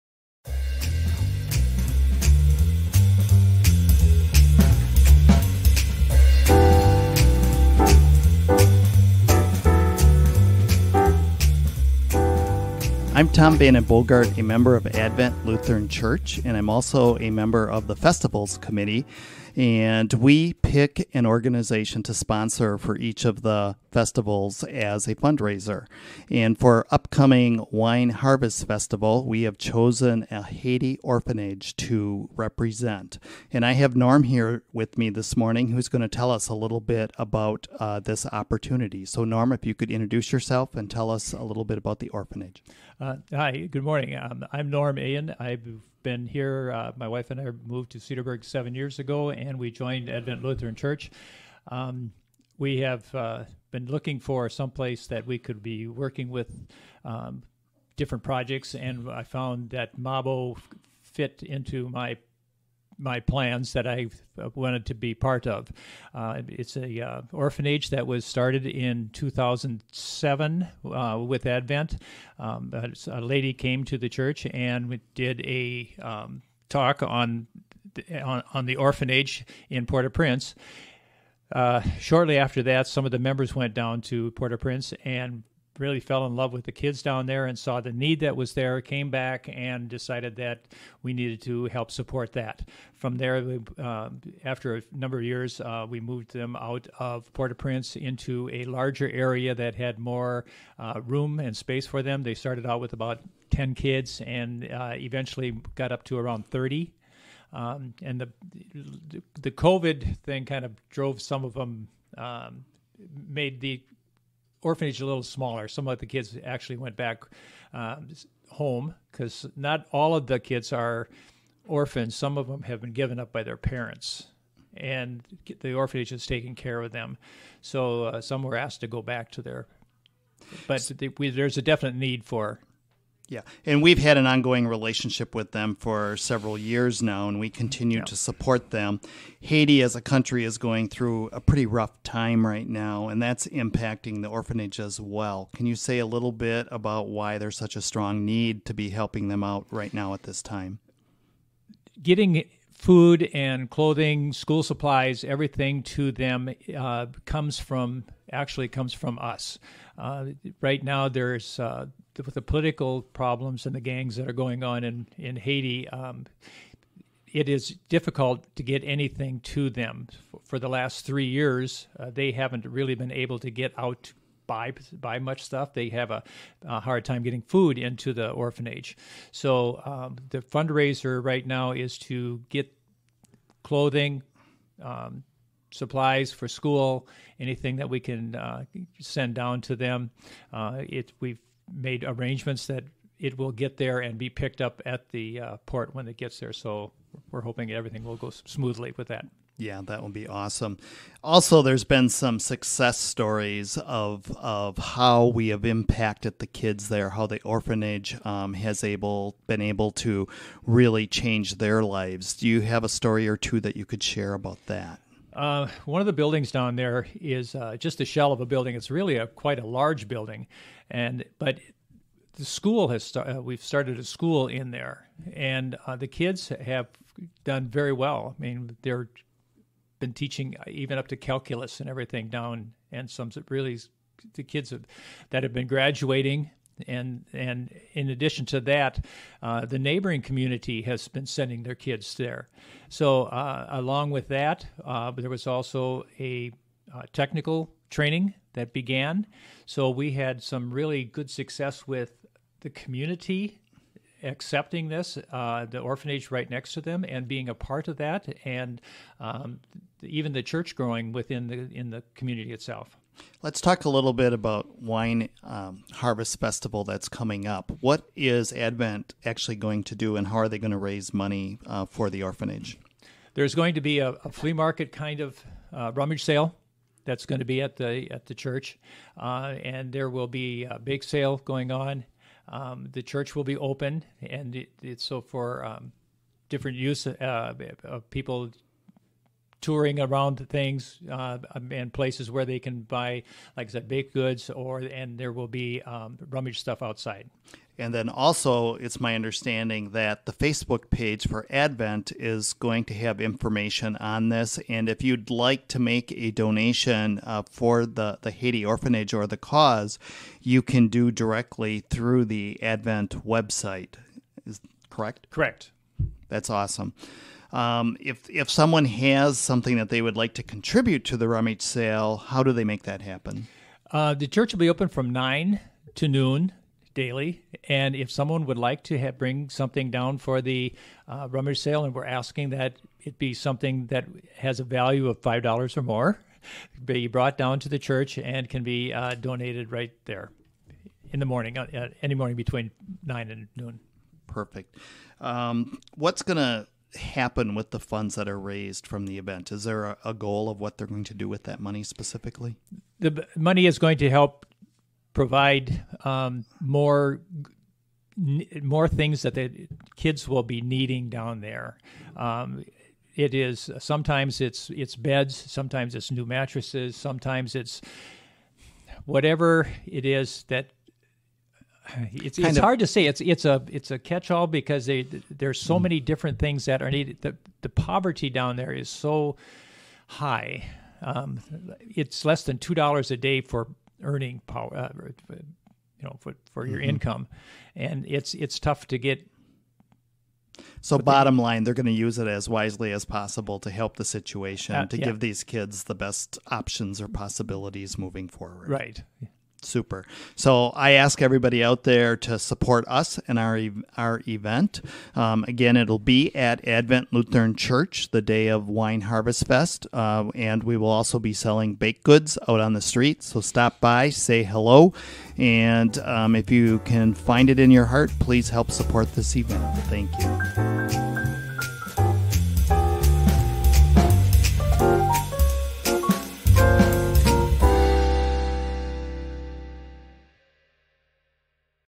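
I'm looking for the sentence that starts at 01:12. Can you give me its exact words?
Um, a lady came to the church and did a um, talk on, on on the orphanage in Port-au-Prince.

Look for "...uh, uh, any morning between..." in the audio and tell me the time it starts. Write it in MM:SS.
05:41.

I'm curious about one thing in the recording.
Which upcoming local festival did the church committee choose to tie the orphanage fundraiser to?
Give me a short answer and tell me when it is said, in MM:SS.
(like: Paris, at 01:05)
Wine Harvest Festival, at 00:27.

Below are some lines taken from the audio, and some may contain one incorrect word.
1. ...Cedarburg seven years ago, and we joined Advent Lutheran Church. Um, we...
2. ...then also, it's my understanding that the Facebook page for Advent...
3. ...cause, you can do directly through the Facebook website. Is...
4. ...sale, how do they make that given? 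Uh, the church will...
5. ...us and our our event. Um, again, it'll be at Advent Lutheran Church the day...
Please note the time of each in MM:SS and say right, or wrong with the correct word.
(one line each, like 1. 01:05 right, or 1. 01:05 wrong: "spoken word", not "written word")
1. 00:47 right
2. 04:57 right
3. 05:09 wrong: "Advent", not "Facebook"
4. 05:21 wrong: "happen", not "given"
5. 06:42 right.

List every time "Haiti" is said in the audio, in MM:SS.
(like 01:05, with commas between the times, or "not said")
00:30, 02:19, 02:45, 05:08.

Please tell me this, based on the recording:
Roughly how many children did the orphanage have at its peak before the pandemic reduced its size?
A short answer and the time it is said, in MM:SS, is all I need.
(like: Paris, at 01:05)
30, at 01:46.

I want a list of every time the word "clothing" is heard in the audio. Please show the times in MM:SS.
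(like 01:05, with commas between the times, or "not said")
02:33, 03:03.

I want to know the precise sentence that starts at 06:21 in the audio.
Um, it's less than two dollars a day for earning power.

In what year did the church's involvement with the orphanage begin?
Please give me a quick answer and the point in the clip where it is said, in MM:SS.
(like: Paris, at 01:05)
2007, at 01:09.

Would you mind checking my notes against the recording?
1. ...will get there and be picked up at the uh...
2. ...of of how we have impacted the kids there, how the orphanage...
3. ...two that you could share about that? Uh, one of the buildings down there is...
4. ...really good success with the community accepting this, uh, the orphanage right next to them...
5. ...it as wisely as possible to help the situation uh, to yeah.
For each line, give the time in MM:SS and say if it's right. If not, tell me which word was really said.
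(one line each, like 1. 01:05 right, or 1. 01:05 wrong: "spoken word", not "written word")
1. 03:13 right
2. 03:23 right
3. 03:33 right
4. 04:10 right
5. 06:32 right.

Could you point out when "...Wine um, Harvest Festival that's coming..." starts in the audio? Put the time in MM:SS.
04:24.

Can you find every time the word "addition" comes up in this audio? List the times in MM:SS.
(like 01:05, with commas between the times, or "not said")
03:58.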